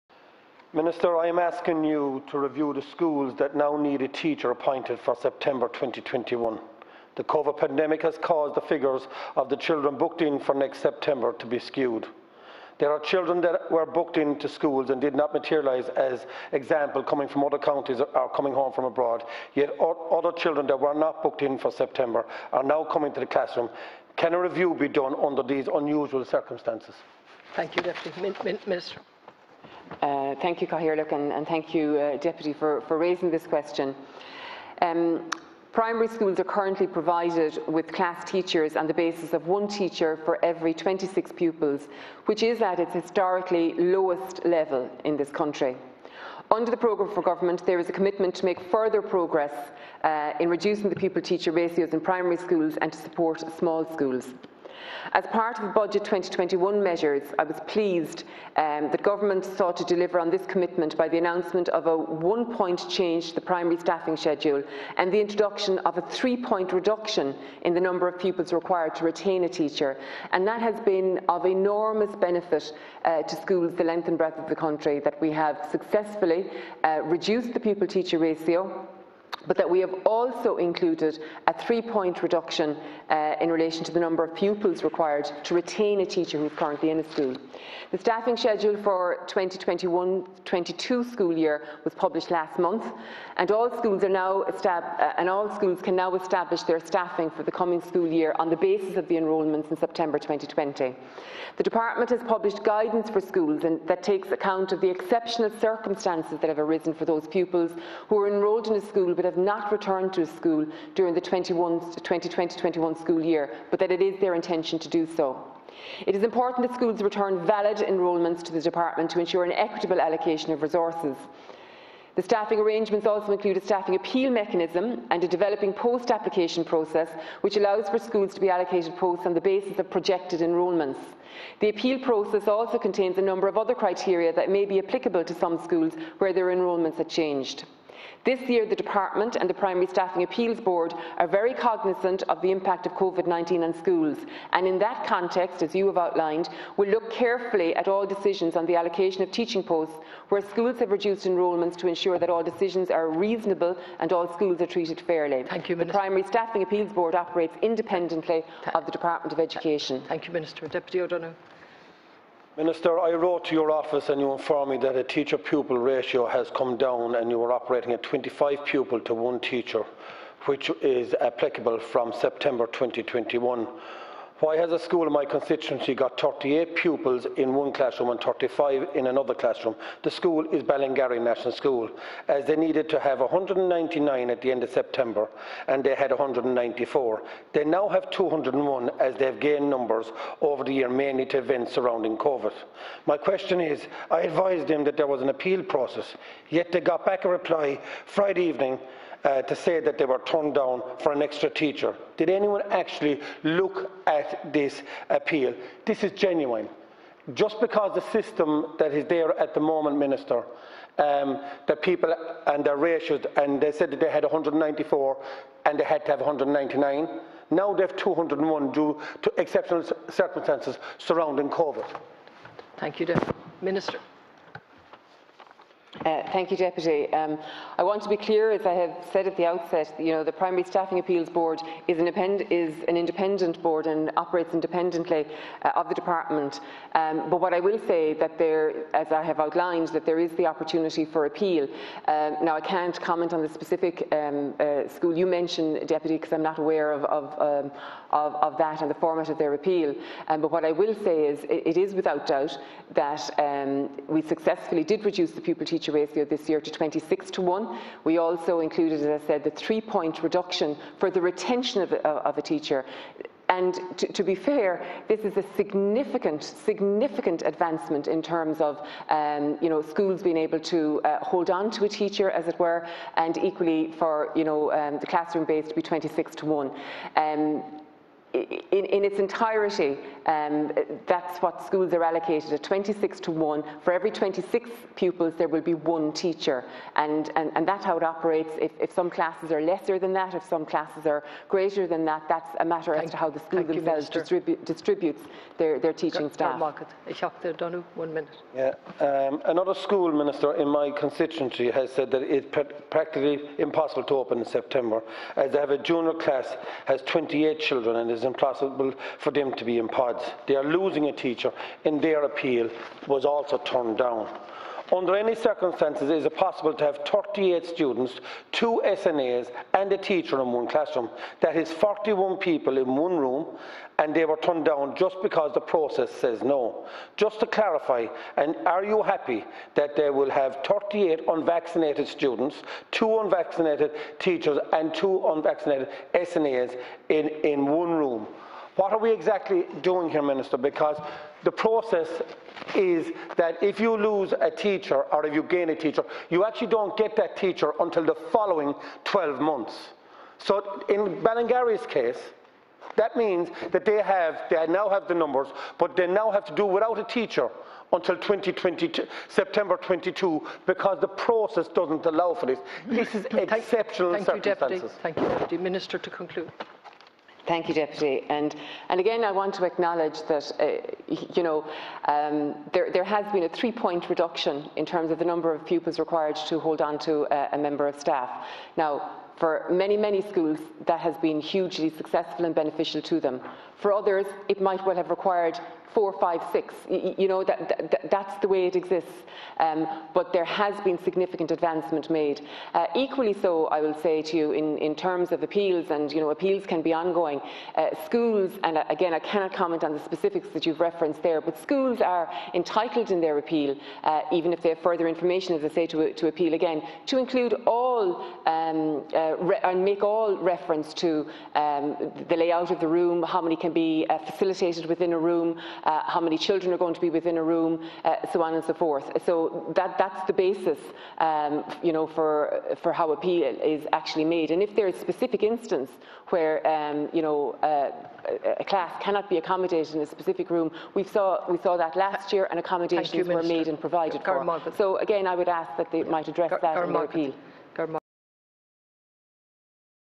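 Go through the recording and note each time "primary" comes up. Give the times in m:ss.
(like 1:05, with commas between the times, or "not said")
0:35, 0:52, 1:03, 2:19, 2:35, 3:50.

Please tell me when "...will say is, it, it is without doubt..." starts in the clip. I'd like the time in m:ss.
4:10.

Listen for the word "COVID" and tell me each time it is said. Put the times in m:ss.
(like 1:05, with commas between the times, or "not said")
0:07, 2:22, 3:12, 3:41.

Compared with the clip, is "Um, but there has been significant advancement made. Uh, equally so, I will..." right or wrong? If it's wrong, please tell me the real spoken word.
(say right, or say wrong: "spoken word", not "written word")
right.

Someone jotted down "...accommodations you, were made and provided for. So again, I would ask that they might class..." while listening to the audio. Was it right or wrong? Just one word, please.
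wrong.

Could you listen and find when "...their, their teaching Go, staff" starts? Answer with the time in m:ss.
4:55.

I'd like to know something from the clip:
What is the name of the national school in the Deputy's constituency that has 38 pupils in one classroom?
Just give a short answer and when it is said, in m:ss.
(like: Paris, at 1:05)
Ballingarry National School, at 3:00.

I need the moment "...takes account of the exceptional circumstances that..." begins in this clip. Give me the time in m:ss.
1:44.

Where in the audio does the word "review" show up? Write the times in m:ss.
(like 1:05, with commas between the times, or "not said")
0:02, 0:24.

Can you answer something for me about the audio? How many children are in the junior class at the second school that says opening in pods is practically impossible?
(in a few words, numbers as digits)
28.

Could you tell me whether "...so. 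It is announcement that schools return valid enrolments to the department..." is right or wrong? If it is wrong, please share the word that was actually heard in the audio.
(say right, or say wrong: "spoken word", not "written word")
wrong: "important", not "announcement".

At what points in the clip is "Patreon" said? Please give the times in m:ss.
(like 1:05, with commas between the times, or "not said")
not said.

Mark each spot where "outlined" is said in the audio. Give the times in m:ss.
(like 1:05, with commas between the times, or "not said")
2:25, 3:59.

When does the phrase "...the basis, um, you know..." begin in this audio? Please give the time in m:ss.
7:00.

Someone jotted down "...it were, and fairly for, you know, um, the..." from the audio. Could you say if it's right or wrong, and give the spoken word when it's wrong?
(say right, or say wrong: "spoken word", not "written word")
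wrong: "equally", not "fairly".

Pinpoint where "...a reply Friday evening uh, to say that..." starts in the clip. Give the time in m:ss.
3:17.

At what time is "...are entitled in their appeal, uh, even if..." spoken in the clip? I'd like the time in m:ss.
6:41.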